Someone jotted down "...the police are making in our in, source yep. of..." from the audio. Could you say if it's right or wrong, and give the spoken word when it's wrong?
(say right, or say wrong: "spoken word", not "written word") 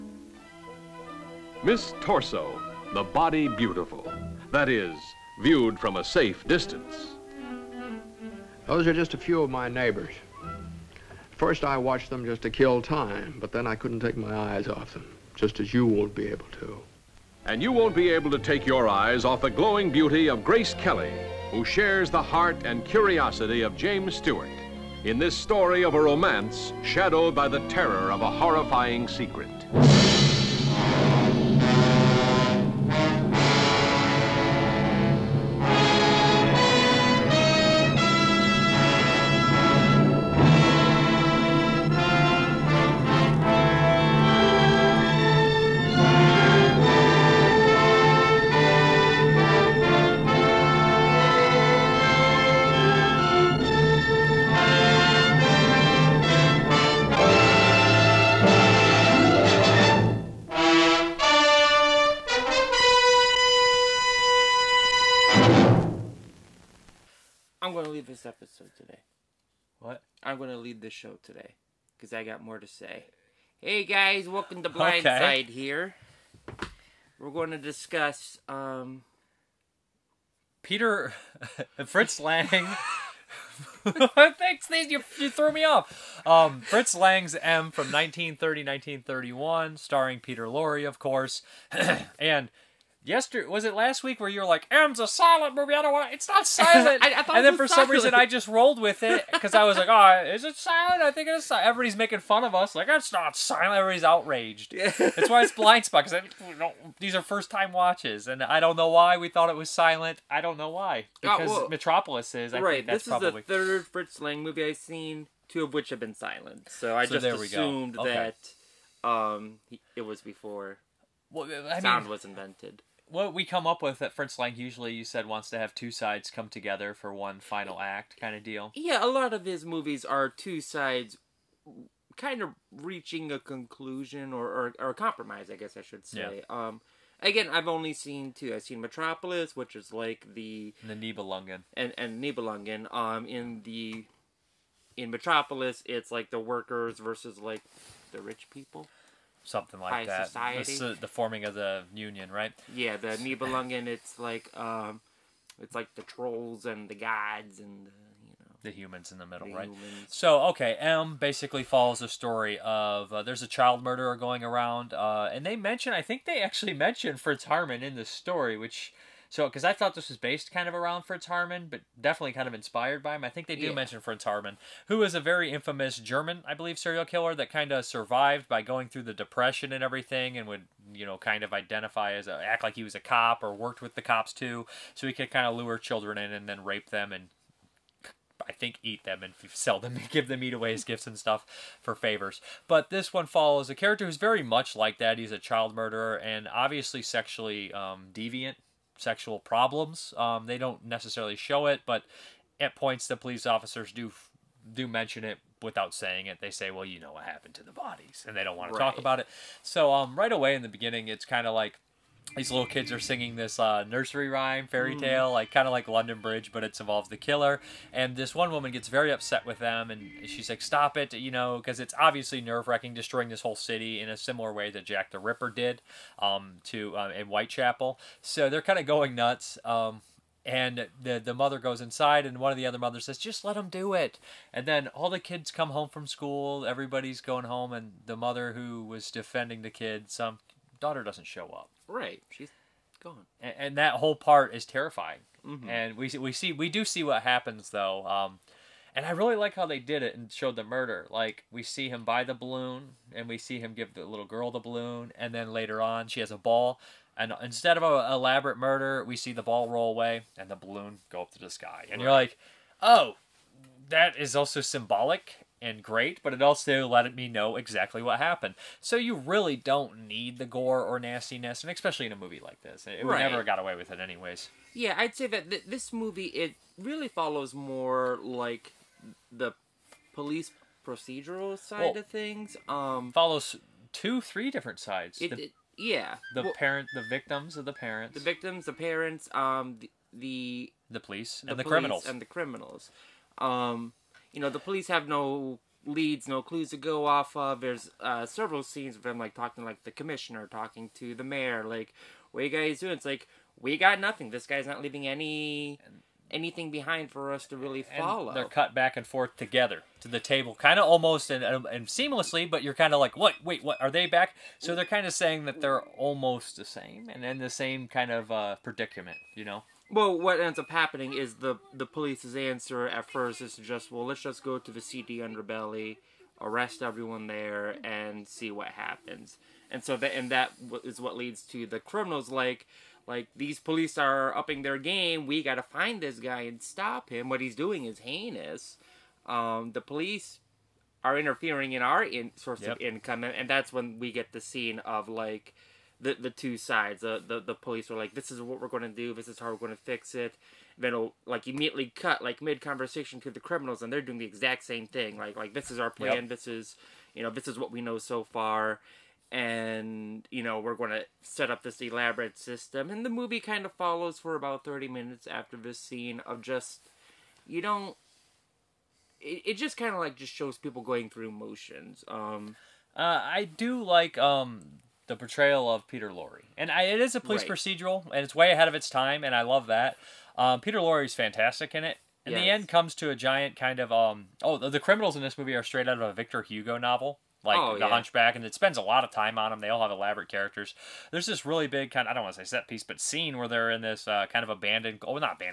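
wrong: "interfering", not "making".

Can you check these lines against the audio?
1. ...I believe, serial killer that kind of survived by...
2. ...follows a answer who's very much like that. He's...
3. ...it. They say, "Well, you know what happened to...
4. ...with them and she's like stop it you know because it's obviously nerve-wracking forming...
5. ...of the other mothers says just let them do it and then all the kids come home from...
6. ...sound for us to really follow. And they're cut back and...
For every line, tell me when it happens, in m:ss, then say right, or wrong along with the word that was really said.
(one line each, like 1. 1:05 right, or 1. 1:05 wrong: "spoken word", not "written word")
1. 2:56 right
2. 3:13 wrong: "character", not "answer"
3. 3:26 right
4. 3:39 wrong: "destroying", not "forming"
5. 3:52 right
6. 5:06 wrong: "behind", not "sound".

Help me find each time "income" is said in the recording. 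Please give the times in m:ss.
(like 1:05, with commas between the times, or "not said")
5:42.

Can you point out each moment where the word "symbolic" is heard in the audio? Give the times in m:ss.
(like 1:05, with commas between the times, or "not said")
4:24.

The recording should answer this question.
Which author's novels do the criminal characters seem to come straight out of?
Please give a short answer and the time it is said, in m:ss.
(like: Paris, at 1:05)
Victor Hugo, at 6:26.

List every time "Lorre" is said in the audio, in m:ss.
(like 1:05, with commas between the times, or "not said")
1:30, 6:16.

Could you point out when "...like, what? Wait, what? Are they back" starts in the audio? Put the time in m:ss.
5:12.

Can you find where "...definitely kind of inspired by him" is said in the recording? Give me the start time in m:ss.
2:51.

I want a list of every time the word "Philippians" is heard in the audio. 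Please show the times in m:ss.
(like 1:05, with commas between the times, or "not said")
not said.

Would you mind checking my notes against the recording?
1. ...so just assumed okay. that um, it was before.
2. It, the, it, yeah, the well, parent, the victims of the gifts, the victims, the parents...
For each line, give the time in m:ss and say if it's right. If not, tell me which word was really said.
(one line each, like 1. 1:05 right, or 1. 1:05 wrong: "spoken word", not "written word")
1. 1:57 right
2. 4:45 wrong: "parents", not "gifts".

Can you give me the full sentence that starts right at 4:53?
Um, you know, the police have no leads, no clues to go off of.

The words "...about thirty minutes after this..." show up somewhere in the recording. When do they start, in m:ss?
6:04.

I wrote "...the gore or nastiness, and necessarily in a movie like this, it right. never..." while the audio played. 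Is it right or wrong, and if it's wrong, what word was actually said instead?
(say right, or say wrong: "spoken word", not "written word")
wrong: "especially", not "necessarily".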